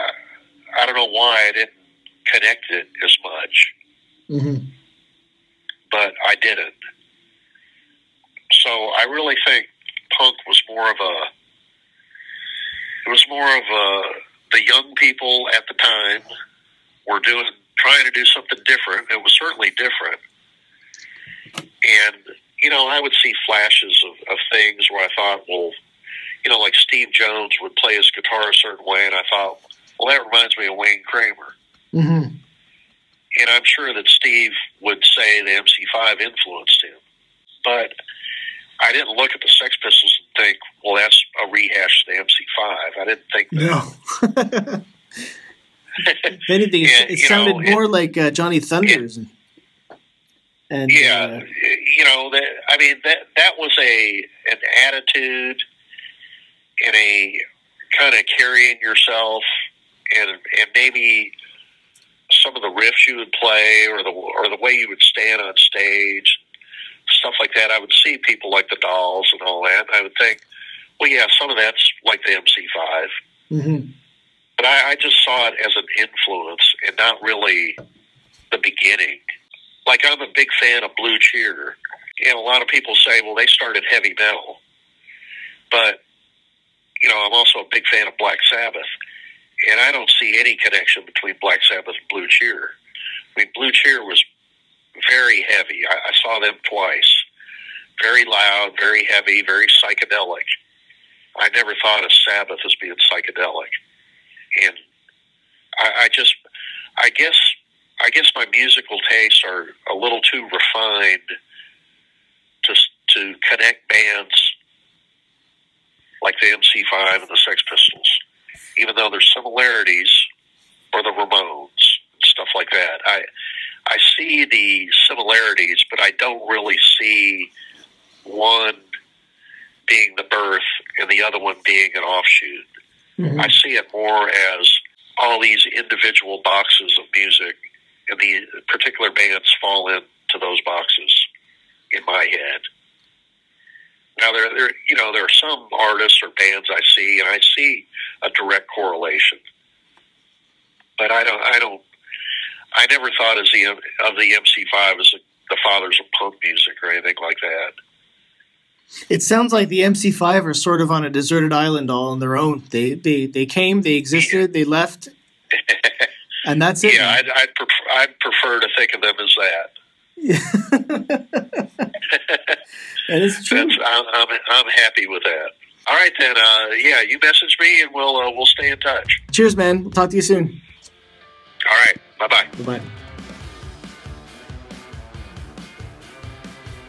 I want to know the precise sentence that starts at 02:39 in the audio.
It sounds like the MC5 are sort of on a deserted island all on their own.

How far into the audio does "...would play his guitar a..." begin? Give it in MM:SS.
00:27.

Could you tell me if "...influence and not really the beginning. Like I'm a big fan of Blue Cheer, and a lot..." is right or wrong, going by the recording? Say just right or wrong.
right.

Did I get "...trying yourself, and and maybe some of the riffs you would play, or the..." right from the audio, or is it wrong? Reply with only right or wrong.
wrong.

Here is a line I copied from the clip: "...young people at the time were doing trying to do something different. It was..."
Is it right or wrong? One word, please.
right.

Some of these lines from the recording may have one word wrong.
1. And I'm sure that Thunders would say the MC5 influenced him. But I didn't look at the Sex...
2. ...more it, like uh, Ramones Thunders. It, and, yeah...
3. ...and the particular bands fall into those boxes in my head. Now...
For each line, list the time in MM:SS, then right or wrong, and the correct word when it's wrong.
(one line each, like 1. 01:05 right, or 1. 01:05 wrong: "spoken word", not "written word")
1. 00:33 wrong: "Steve", not "Thunders"
2. 00:47 wrong: "Johnny", not "Ramones"
3. 02:18 right.